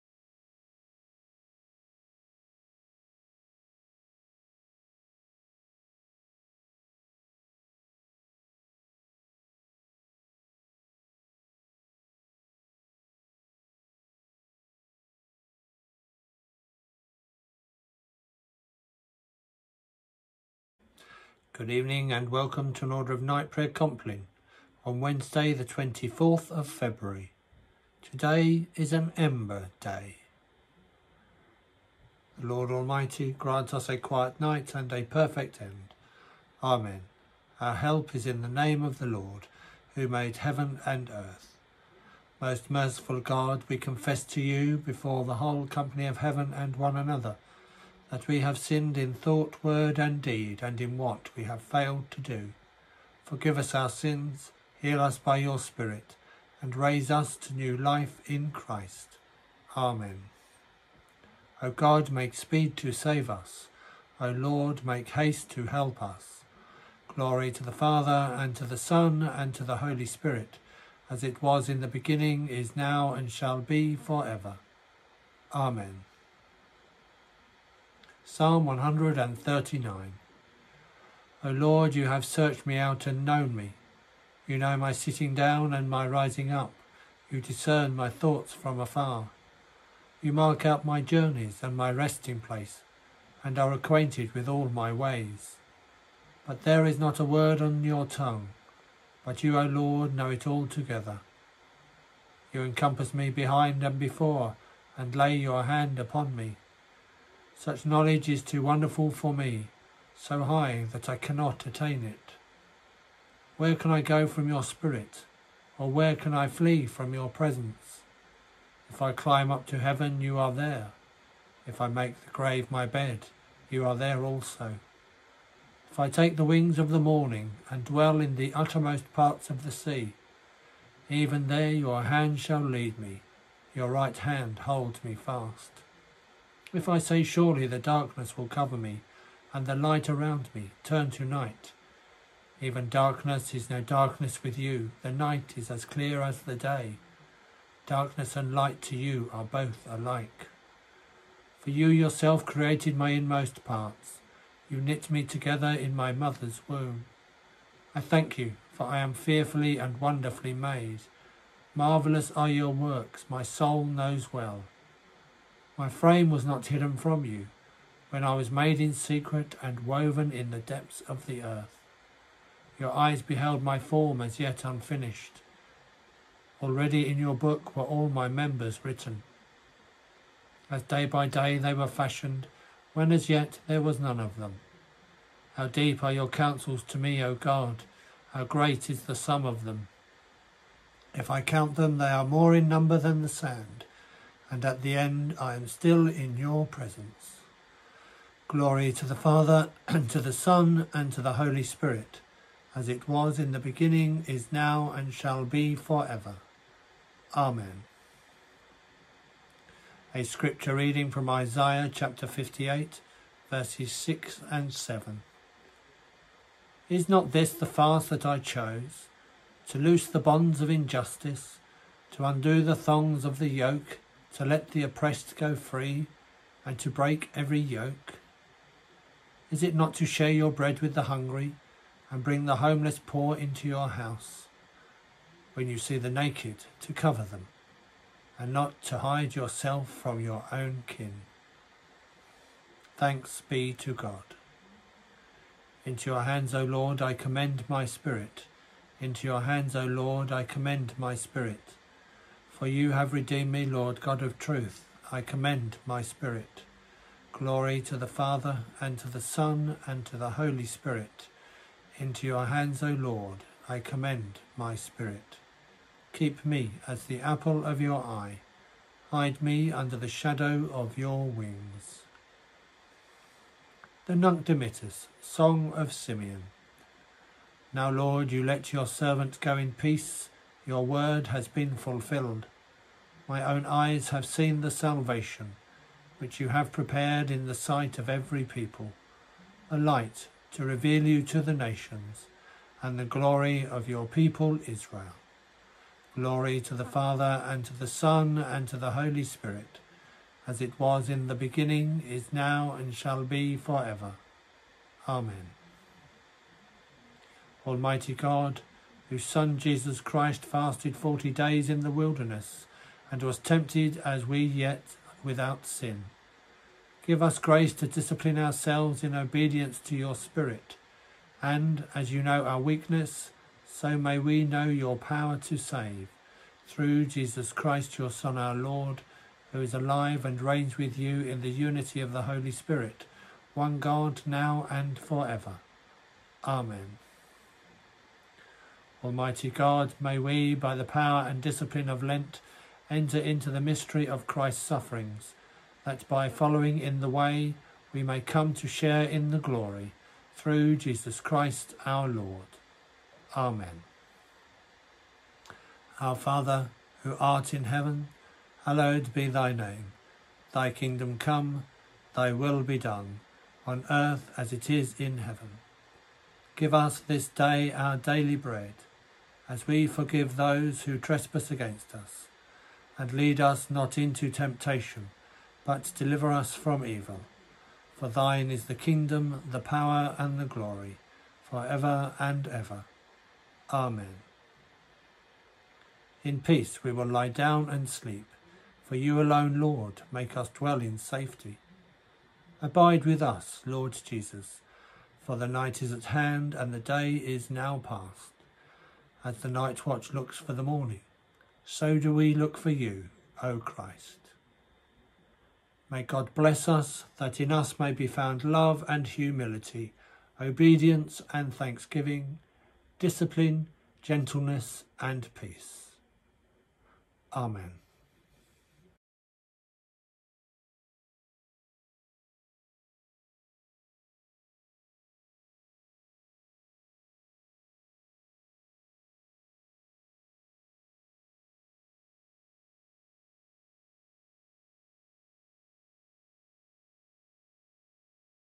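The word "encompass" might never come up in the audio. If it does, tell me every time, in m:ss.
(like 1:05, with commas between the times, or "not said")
1:42.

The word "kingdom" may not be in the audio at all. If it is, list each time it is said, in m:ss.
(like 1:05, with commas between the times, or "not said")
6:00, 6:18.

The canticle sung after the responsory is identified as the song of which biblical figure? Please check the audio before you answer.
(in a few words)
Simeon.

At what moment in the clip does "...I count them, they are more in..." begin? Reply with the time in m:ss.
3:11.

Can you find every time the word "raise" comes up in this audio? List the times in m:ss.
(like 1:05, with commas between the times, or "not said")
0:56.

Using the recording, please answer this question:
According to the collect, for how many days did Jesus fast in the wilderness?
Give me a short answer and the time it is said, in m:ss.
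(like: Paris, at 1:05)
40, at 5:10.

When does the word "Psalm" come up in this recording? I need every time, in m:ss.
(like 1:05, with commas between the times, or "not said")
1:18.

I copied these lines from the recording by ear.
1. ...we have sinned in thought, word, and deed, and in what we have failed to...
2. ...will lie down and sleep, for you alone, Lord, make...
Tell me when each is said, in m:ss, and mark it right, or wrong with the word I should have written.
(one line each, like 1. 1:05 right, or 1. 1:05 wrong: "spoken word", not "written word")
1. 0:48 right
2. 6:26 right.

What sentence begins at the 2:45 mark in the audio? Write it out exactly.
My frame was not hidden from you when I was made in secret and woven in the depths of the earth.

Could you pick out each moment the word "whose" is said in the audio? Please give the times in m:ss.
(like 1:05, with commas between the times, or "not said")
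5:09.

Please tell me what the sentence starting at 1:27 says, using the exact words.
You discern my thoughts from afar.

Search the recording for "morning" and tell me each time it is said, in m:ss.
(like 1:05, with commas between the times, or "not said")
2:06, 6:40.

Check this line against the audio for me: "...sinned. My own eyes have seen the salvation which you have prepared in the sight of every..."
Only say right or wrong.
wrong.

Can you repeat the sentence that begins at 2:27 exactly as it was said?
Darkness and light to you are both alike.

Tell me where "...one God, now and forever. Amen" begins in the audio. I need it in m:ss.
5:33.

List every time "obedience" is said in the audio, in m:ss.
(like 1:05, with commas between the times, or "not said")
5:19, 6:50.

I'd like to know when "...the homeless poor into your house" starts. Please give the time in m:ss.
3:52.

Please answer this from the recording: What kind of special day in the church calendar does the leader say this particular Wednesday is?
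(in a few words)
Ember Day.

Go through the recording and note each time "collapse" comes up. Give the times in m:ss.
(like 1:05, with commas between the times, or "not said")
not said.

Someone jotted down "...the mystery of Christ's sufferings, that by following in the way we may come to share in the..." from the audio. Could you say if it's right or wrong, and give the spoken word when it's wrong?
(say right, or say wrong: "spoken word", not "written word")
right.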